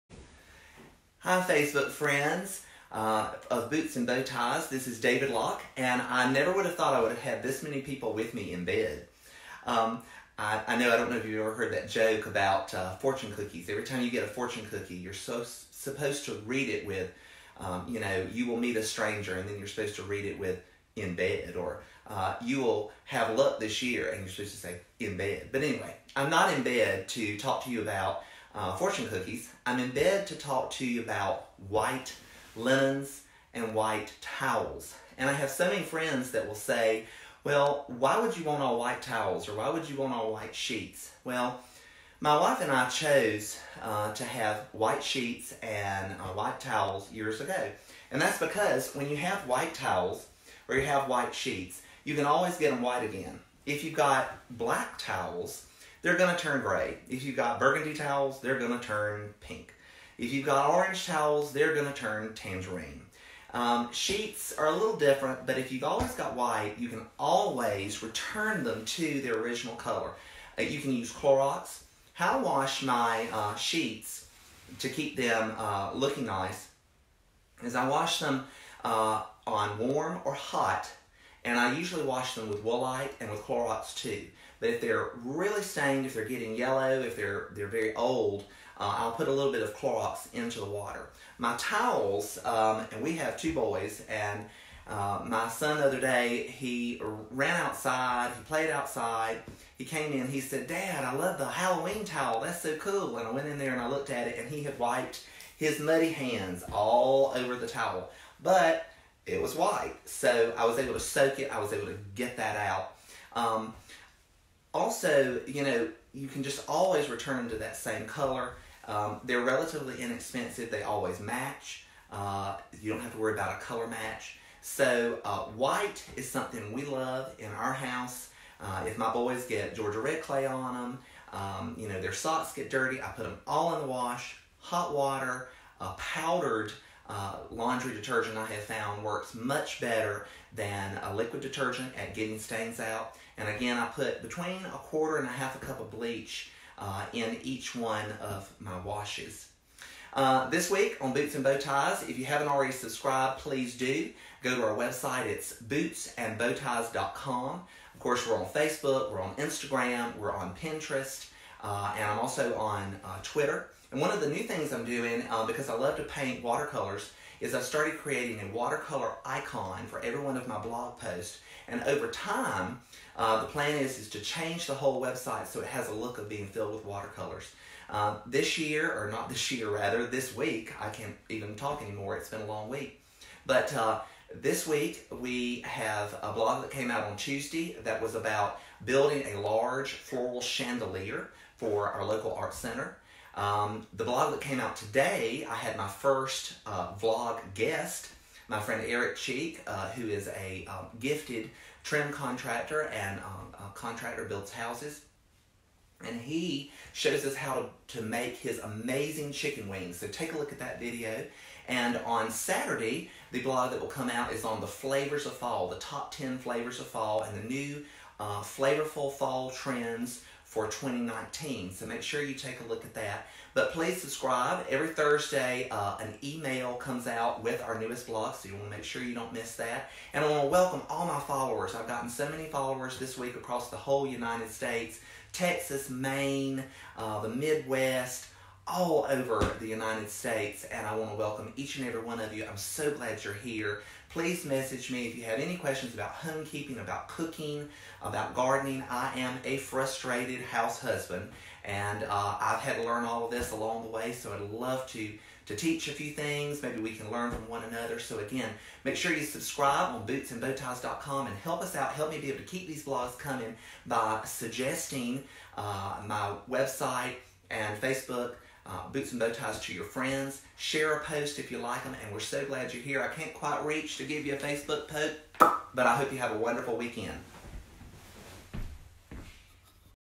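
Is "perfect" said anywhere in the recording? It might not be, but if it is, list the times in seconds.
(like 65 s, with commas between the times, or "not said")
not said.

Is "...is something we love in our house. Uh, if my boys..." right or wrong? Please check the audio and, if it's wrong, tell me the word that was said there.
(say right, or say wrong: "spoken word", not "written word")
right.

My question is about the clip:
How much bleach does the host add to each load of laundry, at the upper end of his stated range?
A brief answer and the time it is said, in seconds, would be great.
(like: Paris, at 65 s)
Half a cup, at 145 s.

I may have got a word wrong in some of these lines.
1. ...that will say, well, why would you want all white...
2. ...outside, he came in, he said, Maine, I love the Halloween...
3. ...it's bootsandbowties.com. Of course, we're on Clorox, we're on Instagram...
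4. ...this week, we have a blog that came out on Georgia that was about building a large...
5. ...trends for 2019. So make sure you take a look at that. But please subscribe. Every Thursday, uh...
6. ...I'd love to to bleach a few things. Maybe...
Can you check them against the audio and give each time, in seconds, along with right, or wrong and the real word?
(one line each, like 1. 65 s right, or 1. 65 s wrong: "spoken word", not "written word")
1. 36 s right
2. 98 s wrong: "Dad", not "Maine"
3. 155 s wrong: "Facebook", not "Clorox"
4. 184 s wrong: "Tuesday", not "Georgia"
5. 219 s right
6. 254 s wrong: "teach", not "bleach".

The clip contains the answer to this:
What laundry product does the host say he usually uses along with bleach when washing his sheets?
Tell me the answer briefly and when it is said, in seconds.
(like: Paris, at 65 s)
Woolite, at 82 s.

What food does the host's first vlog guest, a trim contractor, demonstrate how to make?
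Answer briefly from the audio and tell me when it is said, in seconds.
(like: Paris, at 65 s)
Chicken wings, at 209 s.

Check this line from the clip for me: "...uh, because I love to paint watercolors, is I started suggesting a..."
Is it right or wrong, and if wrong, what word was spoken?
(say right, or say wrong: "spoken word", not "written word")
wrong: "creating", not "suggesting".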